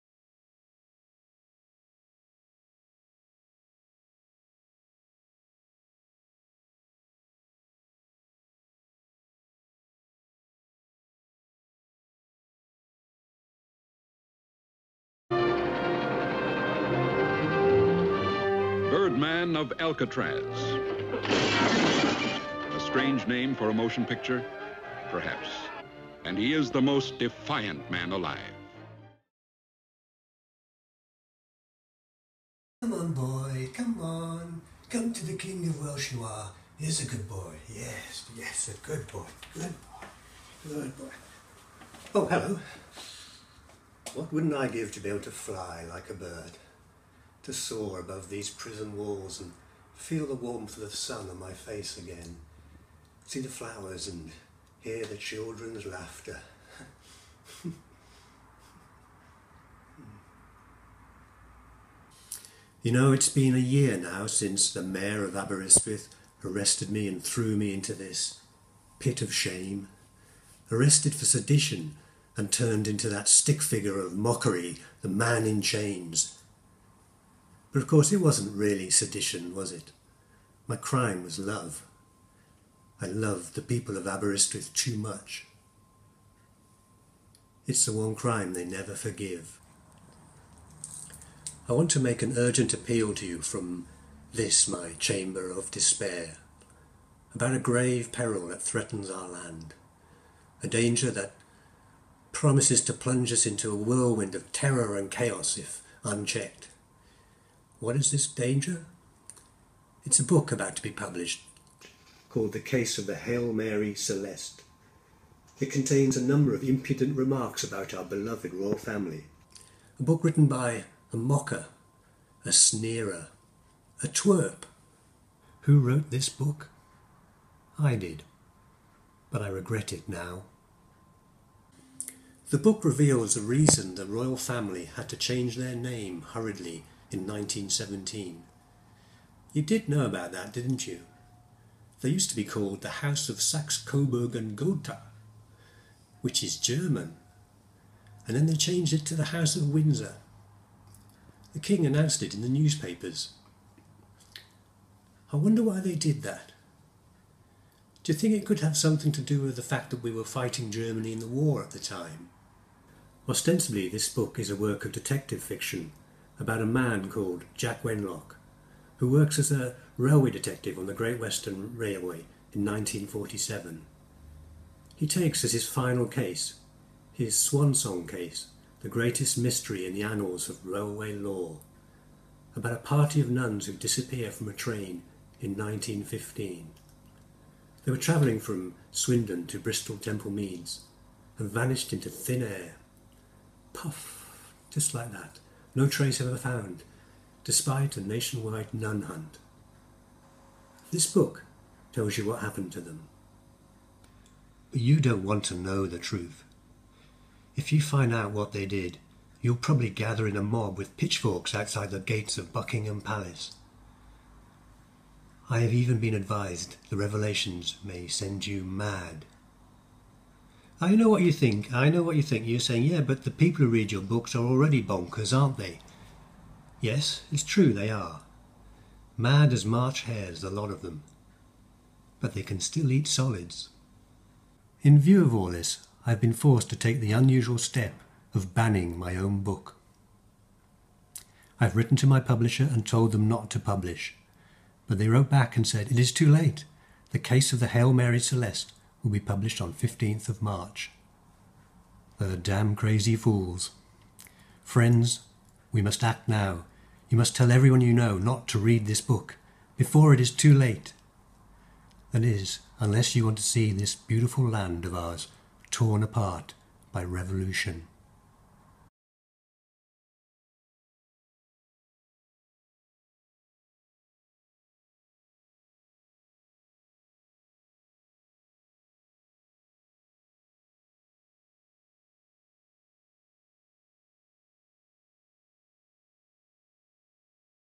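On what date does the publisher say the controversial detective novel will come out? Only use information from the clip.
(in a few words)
15 March.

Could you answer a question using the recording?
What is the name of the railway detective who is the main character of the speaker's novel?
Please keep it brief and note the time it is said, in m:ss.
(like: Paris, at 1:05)
Jack Wenlock, at 2:47.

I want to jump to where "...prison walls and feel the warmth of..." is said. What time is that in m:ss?
0:48.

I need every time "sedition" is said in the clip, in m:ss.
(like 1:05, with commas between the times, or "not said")
1:11, 1:18.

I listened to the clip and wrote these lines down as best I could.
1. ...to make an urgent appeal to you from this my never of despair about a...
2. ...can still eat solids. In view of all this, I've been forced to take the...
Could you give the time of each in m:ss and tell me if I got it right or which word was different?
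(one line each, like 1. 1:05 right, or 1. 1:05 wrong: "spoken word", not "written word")
1. 1:31 wrong: "chamber", not "never"
2. 3:52 right.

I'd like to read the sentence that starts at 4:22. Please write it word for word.
That is, unless you want to see this beautiful land of ours torn apart by revolution.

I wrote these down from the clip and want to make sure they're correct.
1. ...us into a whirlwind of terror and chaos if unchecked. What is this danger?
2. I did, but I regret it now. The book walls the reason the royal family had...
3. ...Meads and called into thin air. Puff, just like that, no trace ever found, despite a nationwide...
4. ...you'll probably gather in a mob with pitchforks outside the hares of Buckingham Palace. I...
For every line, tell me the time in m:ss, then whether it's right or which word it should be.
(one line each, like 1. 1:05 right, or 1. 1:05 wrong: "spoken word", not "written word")
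1. 1:43 right
2. 2:07 wrong: "reveals", not "walls"
3. 3:10 wrong: "vanished", not "called"
4. 3:29 wrong: "gates", not "hares".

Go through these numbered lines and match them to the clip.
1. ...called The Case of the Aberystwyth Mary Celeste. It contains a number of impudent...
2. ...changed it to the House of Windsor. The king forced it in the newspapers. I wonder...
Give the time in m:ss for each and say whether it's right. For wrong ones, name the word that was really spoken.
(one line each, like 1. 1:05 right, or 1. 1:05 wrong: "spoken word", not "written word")
1. 1:52 wrong: "Hail", not "Aberystwyth"
2. 2:28 wrong: "announced", not "forced".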